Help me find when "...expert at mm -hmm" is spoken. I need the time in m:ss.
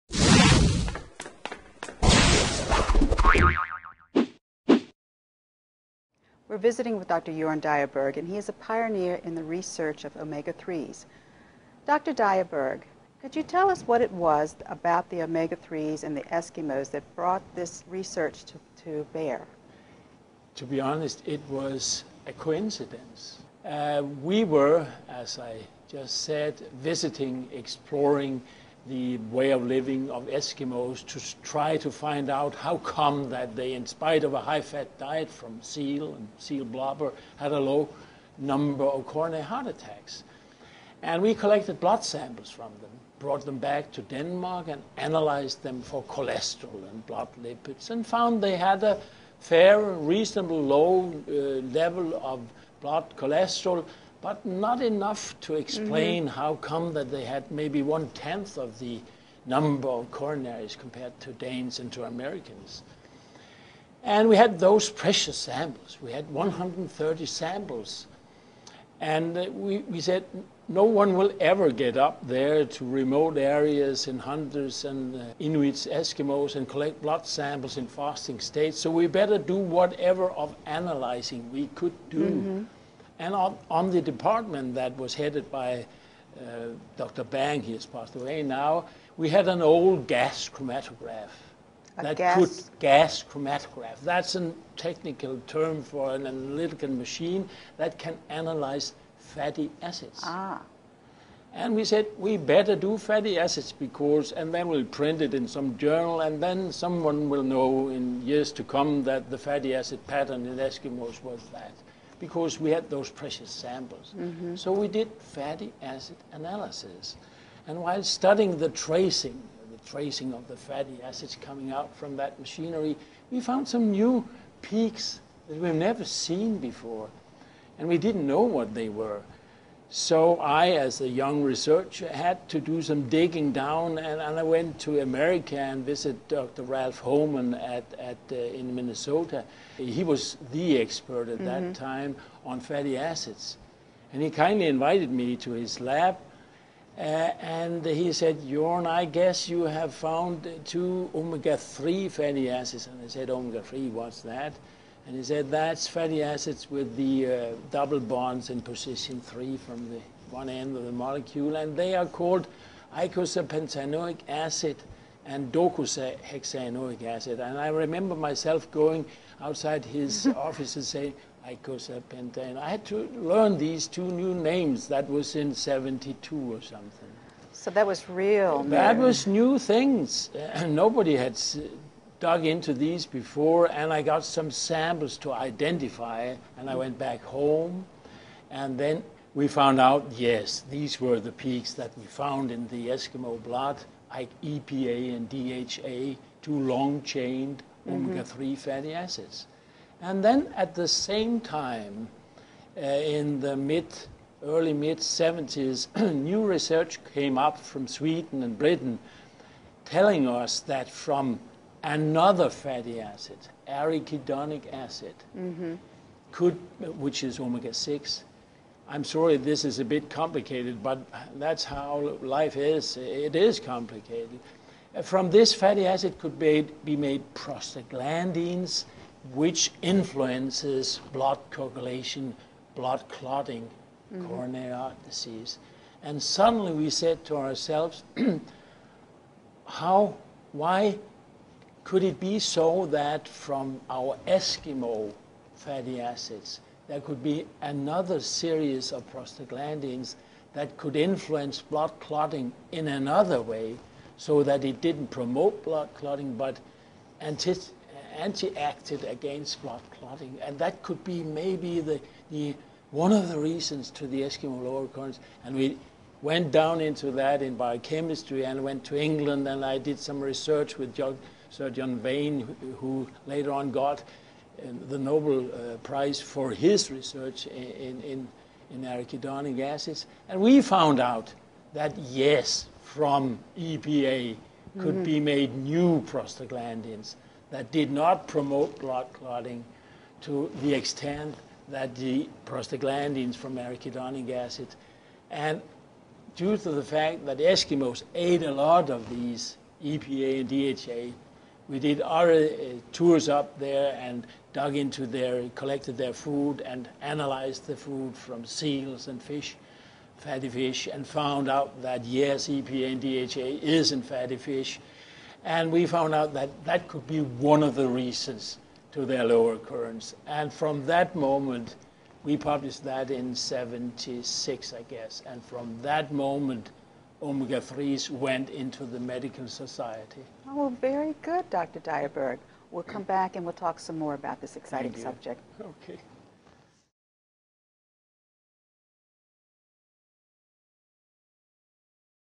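2:20.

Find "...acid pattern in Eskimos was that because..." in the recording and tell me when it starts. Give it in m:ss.
1:49.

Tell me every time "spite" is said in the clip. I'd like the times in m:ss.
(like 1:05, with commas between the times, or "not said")
0:33.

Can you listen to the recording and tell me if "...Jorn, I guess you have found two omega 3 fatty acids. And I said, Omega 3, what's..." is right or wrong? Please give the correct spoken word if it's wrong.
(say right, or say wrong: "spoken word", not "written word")
right.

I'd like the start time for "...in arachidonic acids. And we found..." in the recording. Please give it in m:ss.
4:38.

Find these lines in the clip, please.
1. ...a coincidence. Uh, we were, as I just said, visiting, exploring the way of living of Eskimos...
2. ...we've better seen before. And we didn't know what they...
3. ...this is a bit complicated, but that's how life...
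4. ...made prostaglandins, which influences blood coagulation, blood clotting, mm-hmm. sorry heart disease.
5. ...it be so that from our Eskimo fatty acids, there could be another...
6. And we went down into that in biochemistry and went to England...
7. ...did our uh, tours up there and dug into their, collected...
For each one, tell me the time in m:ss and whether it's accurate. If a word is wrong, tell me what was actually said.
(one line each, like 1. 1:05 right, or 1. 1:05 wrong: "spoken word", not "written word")
1. 0:22 right
2. 2:05 wrong: "never", not "better"
3. 3:39 right
4. 3:46 wrong: "coronary", not "sorry"
5. 4:02 right
6. 4:25 right
7. 5:01 right.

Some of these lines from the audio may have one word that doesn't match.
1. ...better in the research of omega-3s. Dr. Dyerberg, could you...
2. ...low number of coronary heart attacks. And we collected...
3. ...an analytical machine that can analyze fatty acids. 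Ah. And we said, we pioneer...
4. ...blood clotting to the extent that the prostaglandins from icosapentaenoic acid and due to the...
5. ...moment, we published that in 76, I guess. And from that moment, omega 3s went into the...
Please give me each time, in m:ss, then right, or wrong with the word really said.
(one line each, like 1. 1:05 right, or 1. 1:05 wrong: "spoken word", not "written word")
1. 0:08 wrong: "pioneer", not "better"
2. 0:37 right
3. 1:36 wrong: "better", not "pioneer"
4. 4:48 wrong: "arachidonic", not "icosapentaenoic"
5. 5:21 right.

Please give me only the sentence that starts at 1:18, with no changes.
So we better do whatever of analyzing we could do.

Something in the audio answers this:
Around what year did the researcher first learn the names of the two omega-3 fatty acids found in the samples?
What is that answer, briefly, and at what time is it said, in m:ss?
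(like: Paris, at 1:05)
1972, at 2:55.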